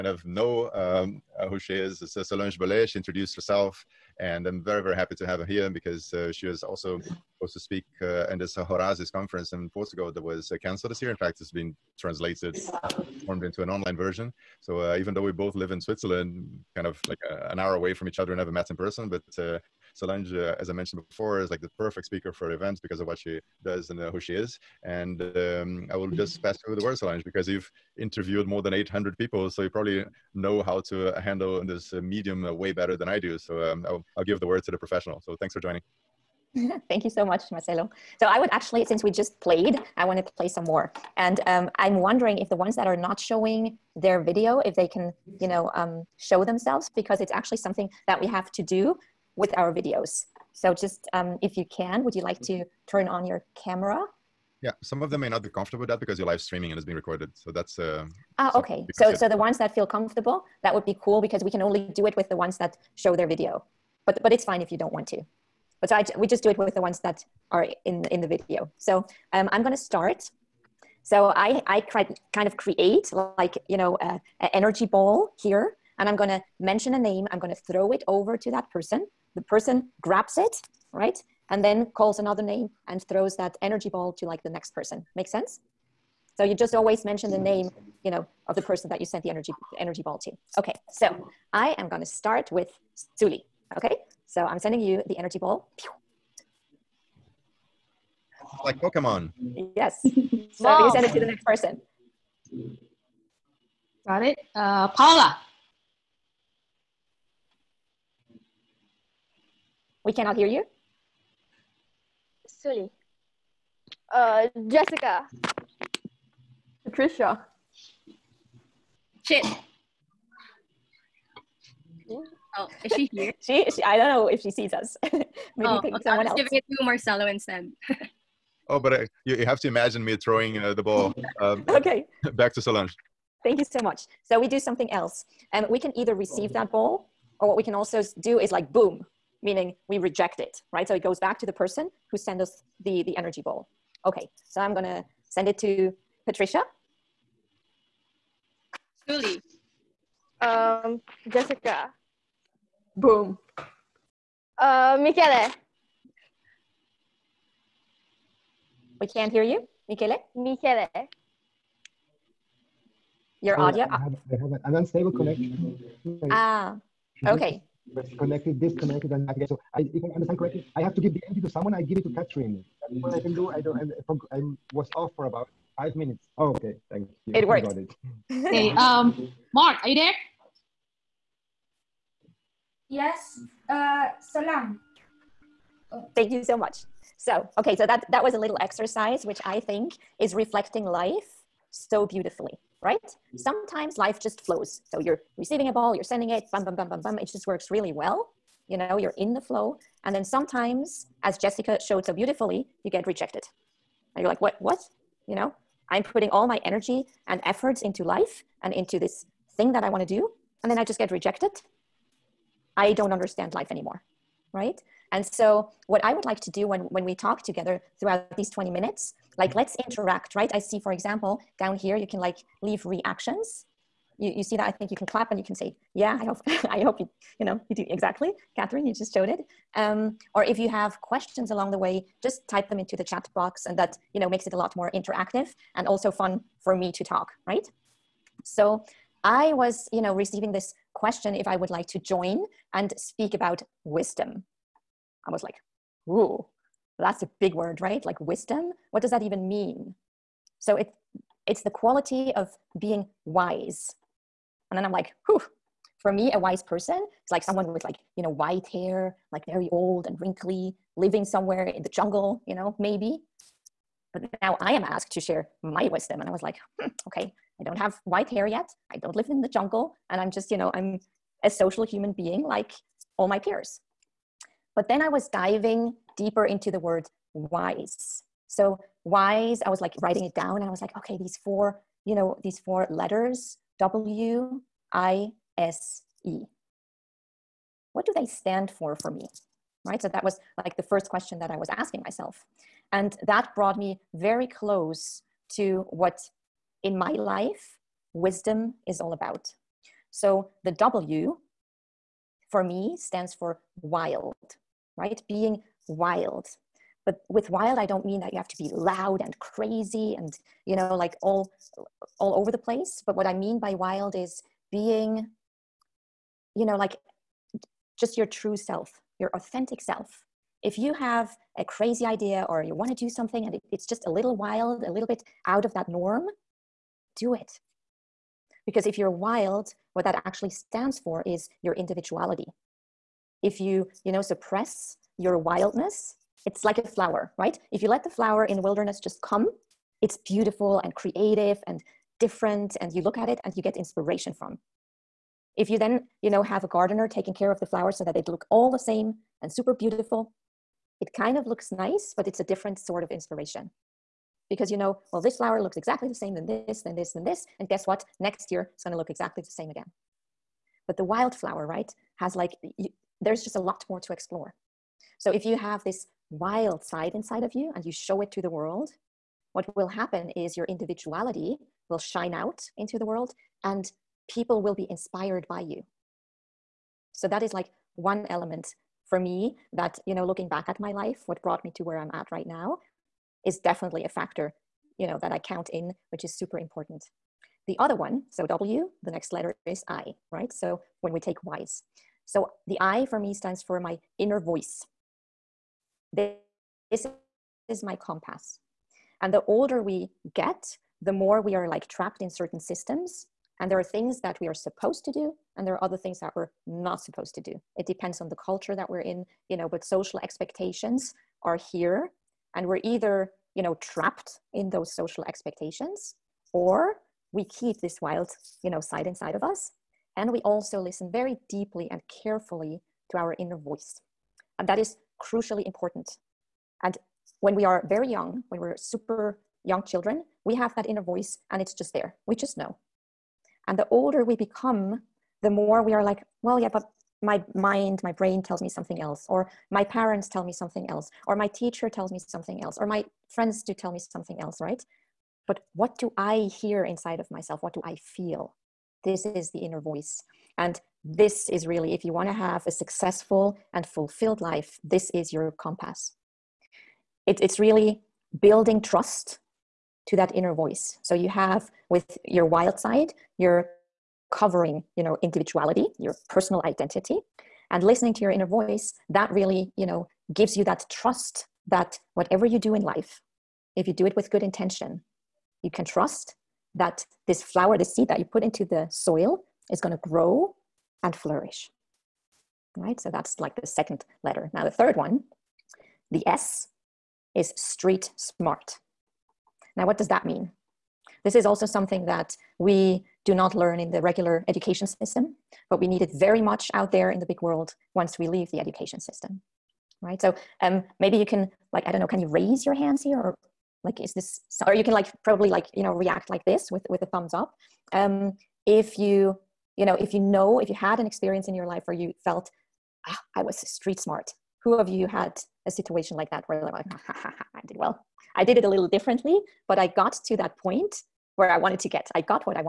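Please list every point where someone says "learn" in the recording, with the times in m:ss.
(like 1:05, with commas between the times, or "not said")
8:13.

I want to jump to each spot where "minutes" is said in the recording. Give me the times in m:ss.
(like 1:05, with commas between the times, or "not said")
2:55, 3:38.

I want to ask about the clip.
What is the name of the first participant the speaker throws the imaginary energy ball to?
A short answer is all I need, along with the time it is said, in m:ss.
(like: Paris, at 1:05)
Suli, at 1:33.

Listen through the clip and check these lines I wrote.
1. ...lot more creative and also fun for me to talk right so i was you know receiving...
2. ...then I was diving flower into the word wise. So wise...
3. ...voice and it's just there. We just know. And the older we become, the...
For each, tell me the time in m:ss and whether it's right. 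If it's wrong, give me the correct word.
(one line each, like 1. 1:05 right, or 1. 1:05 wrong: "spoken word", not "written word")
1. 3:54 wrong: "interactive", not "creative"
2. 4:34 wrong: "deeper", not "flower"
3. 7:11 right.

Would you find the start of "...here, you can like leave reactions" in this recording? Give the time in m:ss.
3:41.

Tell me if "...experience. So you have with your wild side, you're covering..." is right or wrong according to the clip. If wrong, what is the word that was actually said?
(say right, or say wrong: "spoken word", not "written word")
wrong: "voice", not "experience".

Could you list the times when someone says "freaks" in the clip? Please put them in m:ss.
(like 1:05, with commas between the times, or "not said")
not said.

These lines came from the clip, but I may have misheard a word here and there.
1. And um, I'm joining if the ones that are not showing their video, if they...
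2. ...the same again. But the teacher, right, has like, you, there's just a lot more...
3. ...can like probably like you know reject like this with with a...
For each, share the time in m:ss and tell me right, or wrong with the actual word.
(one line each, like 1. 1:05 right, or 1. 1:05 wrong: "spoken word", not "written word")
1. 0:41 wrong: "wondering", not "joining"
2. 5:59 wrong: "wildflower", not "teacher"
3. 8:24 wrong: "react", not "reject".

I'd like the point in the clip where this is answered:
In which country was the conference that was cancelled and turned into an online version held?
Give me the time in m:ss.
0:09.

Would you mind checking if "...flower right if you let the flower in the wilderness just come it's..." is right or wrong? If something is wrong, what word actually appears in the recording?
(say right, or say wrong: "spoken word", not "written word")
right.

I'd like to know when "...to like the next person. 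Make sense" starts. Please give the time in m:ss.
1:24.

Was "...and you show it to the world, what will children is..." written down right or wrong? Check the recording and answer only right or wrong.
wrong.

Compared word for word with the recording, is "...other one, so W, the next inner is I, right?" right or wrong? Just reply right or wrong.
wrong.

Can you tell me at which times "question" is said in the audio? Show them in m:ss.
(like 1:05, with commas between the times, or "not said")
3:51, 4:00, 4:51.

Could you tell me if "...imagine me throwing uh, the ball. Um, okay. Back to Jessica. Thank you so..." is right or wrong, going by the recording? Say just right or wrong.
wrong.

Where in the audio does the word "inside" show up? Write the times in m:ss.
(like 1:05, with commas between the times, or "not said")
6:07, 6:59, 7:26.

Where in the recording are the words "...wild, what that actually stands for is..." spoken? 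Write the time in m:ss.
5:29.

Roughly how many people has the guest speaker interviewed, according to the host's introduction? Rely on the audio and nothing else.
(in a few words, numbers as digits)
800.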